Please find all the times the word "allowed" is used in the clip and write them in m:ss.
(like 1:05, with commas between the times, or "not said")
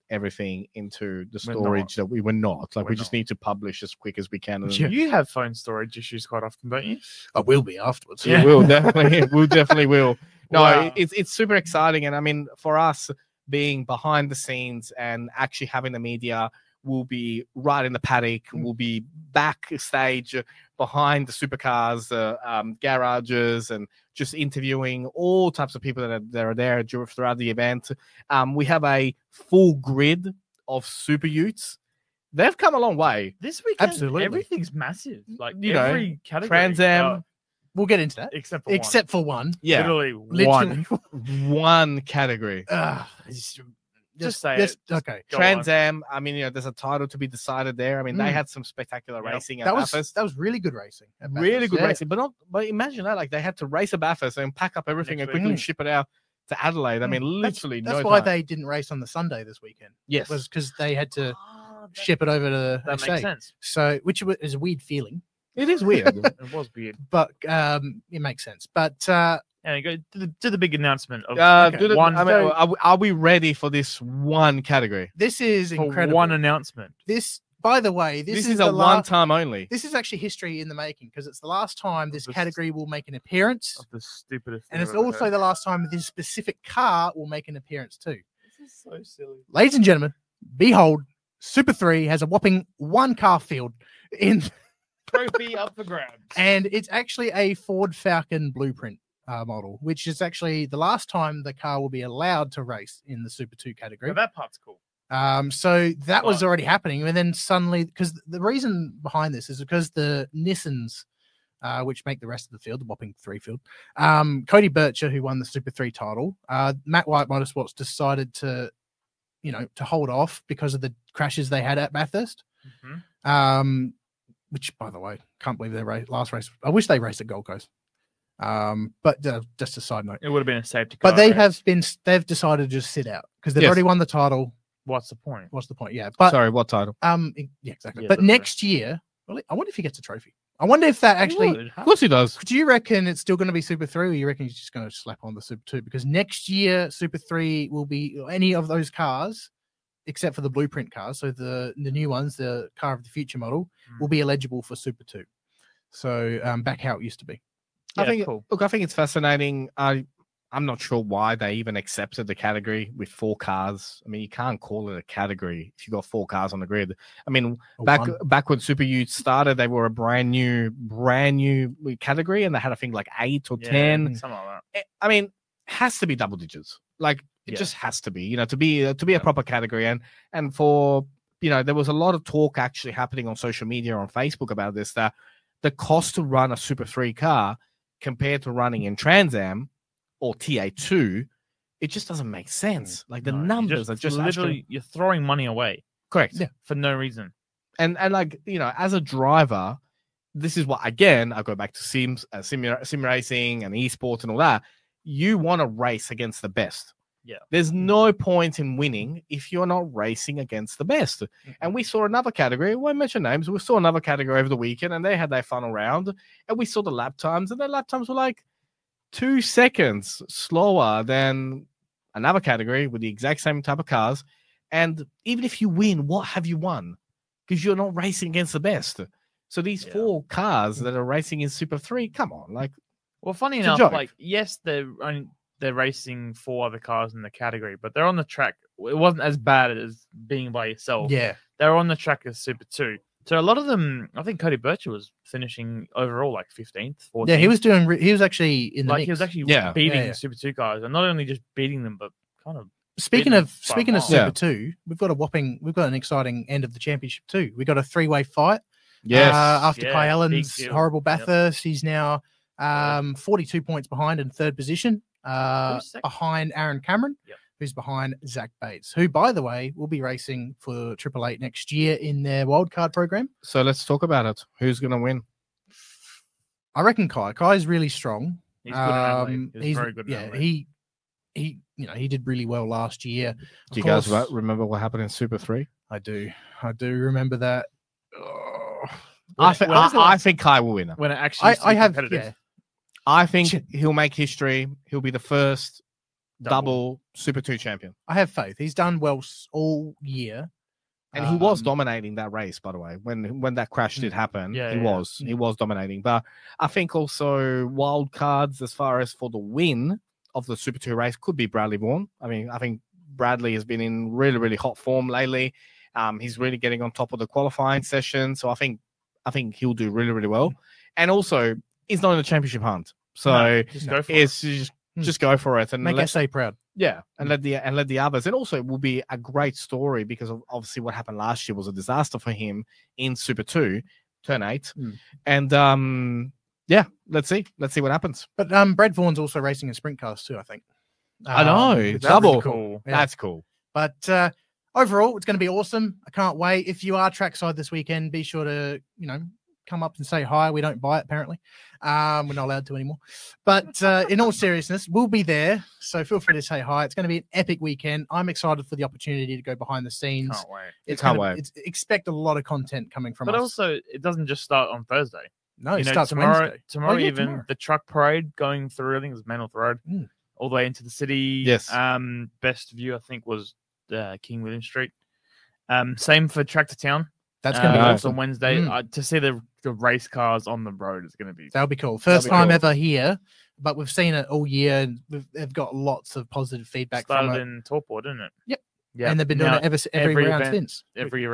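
1:42, 5:52.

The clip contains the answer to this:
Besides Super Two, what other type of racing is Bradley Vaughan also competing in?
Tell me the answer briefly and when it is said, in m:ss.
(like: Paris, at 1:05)
Sprint cars, at 5:39.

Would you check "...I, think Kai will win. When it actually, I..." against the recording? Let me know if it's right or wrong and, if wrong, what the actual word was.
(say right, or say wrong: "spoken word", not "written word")
right.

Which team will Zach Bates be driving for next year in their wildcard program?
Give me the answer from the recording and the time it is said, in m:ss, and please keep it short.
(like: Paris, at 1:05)
Triple Eight, at 4:30.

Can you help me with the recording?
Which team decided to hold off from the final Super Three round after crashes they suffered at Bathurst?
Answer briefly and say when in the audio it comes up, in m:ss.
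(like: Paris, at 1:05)
Matt White Motorsports, at 1:56.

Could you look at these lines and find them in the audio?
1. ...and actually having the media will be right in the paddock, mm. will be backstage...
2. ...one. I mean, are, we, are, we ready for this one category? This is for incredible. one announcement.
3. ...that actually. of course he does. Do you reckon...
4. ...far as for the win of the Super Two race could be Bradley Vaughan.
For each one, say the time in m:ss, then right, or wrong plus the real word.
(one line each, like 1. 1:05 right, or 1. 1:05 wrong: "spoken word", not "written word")
1. 0:14 right
2. 1:11 right
3. 2:20 right
4. 5:08 right.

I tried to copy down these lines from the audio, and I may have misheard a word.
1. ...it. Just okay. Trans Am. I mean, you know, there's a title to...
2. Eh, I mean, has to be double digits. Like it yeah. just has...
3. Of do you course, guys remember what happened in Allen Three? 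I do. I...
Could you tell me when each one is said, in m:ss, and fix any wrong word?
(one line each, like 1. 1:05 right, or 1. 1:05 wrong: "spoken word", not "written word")
1. 0:44 right
2. 2:54 right
3. 4:43 wrong: "Super", not "Allen".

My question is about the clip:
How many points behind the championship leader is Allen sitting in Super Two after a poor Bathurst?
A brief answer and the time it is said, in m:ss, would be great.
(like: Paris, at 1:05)
42, at 4:23.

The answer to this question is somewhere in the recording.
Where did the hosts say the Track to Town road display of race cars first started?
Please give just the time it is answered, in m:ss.
6:27.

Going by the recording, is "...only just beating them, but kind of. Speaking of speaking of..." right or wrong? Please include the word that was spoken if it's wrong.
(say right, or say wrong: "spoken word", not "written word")
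right.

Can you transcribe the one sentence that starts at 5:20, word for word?
And also, He's not in a championship hunt.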